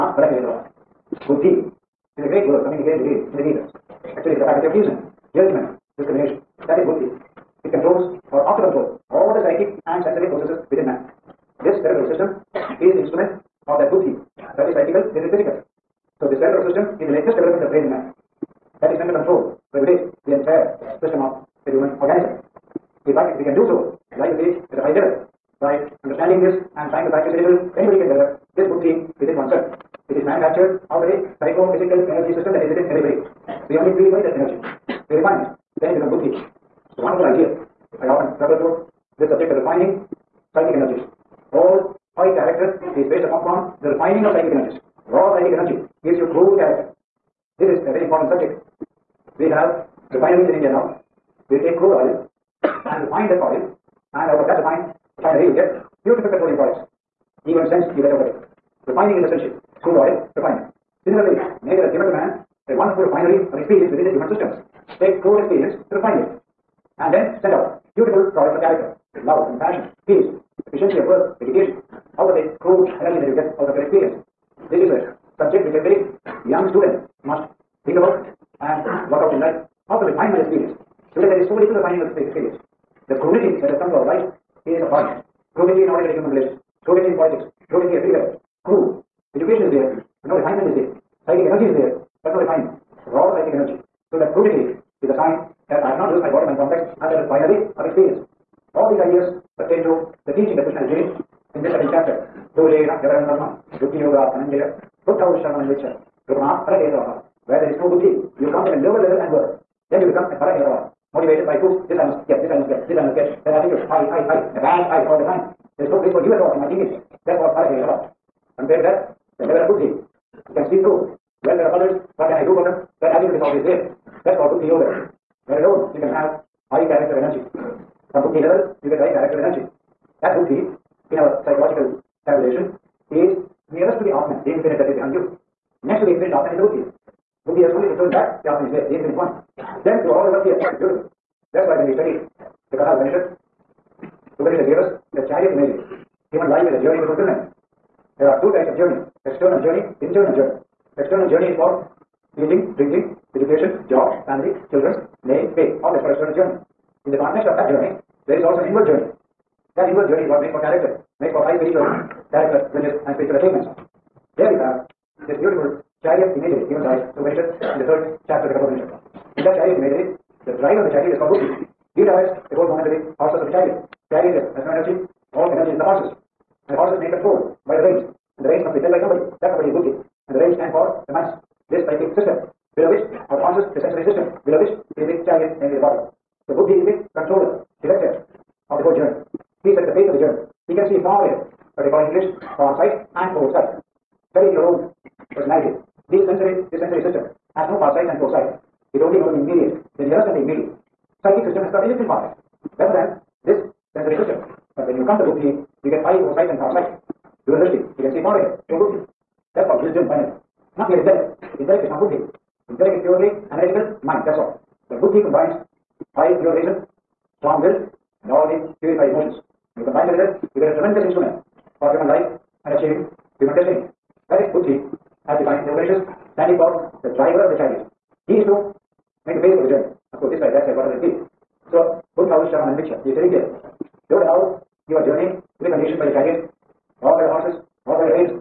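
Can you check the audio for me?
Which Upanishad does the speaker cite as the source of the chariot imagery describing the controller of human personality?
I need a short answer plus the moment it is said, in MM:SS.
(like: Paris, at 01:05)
Kathopanishad, at 02:48.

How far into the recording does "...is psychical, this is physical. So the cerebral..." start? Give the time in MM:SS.
00:14.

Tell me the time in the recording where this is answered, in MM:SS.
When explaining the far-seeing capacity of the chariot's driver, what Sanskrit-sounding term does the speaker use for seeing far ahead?
03:27.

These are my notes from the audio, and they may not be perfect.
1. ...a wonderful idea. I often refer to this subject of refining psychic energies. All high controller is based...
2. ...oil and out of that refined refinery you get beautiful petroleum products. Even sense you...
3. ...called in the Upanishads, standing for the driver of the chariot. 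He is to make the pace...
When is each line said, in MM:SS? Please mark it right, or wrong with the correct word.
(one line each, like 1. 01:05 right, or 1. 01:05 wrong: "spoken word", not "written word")
1. 00:36 wrong: "character", not "controller"
2. 00:53 right
3. 03:45 wrong: "defined", not "called".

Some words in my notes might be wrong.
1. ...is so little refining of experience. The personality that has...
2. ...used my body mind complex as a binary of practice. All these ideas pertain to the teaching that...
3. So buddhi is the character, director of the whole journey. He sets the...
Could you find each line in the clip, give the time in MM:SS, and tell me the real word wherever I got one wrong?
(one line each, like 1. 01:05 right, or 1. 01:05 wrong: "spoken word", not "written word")
1. 01:21 wrong: "crudity", not "personality"
2. 01:36 wrong: "experience", not "practice"
3. 03:06 wrong: "controller", not "character".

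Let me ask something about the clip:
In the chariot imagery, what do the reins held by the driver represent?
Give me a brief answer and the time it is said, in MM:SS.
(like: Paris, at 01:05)
manas, at 03:01.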